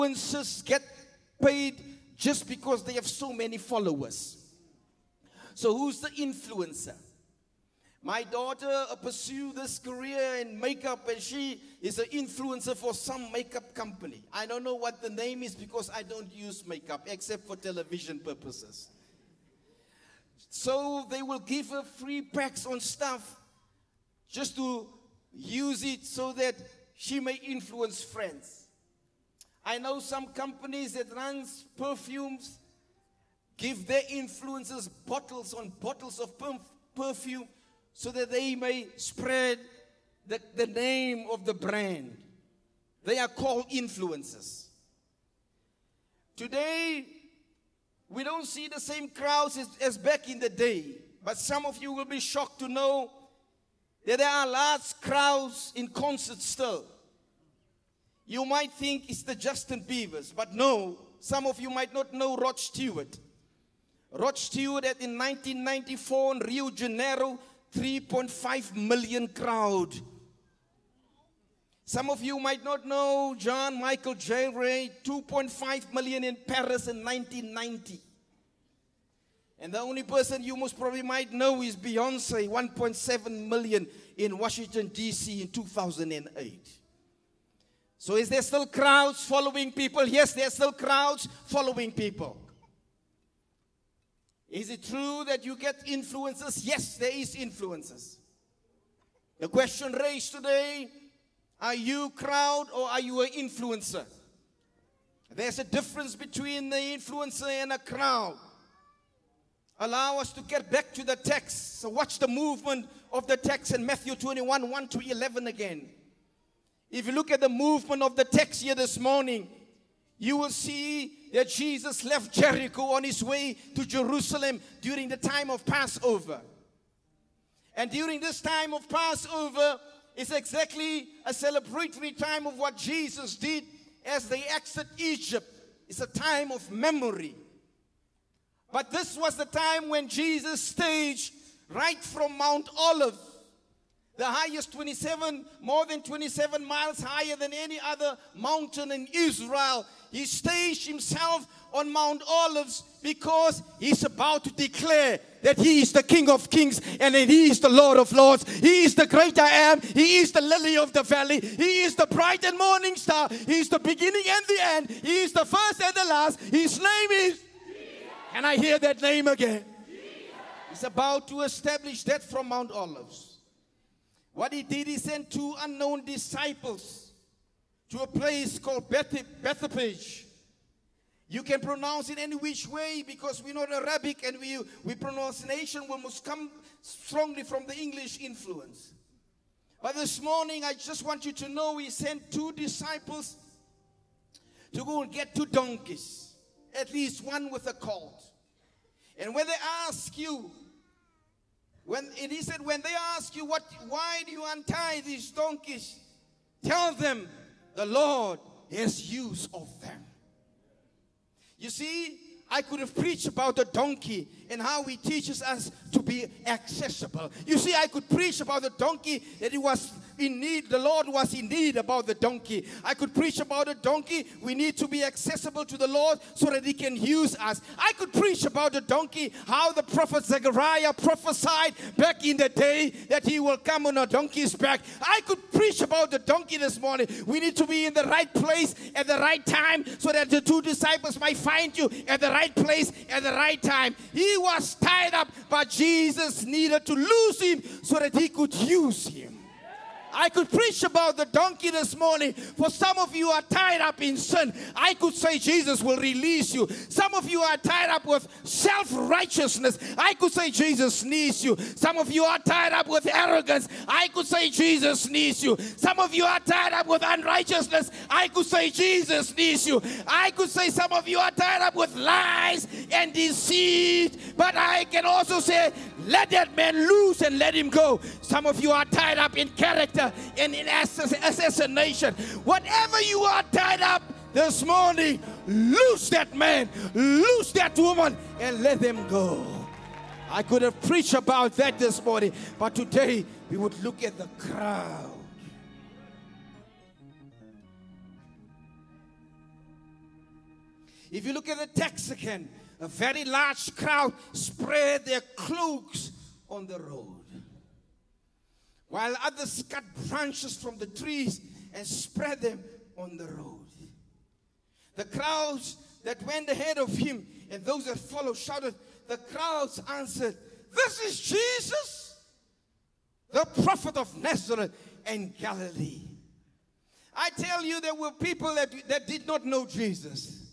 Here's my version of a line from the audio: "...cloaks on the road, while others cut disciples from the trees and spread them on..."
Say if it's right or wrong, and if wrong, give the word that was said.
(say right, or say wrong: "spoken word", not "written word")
wrong: "branches", not "disciples".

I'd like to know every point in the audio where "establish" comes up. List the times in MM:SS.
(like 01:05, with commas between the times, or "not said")
02:51.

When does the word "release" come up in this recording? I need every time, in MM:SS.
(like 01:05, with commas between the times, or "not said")
04:15.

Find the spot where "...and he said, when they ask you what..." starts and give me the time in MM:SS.
03:22.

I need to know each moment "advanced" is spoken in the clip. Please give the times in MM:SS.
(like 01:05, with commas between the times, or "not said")
not said.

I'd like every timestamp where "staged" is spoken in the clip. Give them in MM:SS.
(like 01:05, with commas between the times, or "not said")
02:20, 02:30.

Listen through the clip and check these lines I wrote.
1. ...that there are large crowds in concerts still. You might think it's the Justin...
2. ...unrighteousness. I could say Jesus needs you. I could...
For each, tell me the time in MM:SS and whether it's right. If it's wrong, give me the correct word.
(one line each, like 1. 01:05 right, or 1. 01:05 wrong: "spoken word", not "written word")
1. 00:54 right
2. 04:27 right.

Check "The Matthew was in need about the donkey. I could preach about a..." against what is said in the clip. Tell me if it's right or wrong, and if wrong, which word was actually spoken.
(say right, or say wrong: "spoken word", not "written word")
wrong: "Lord", not "Matthew".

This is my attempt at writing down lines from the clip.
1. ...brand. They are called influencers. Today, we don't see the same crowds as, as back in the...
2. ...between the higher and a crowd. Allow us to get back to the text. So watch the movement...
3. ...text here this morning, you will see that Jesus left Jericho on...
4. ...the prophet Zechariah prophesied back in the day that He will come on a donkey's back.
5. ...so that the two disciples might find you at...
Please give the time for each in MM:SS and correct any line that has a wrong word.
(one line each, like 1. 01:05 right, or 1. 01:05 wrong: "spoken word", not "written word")
1. 00:41 right
2. 01:46 wrong: "influencer", not "higher"
3. 01:58 right
4. 03:49 right
5. 03:59 right.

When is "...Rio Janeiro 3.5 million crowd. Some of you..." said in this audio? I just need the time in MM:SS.
01:06.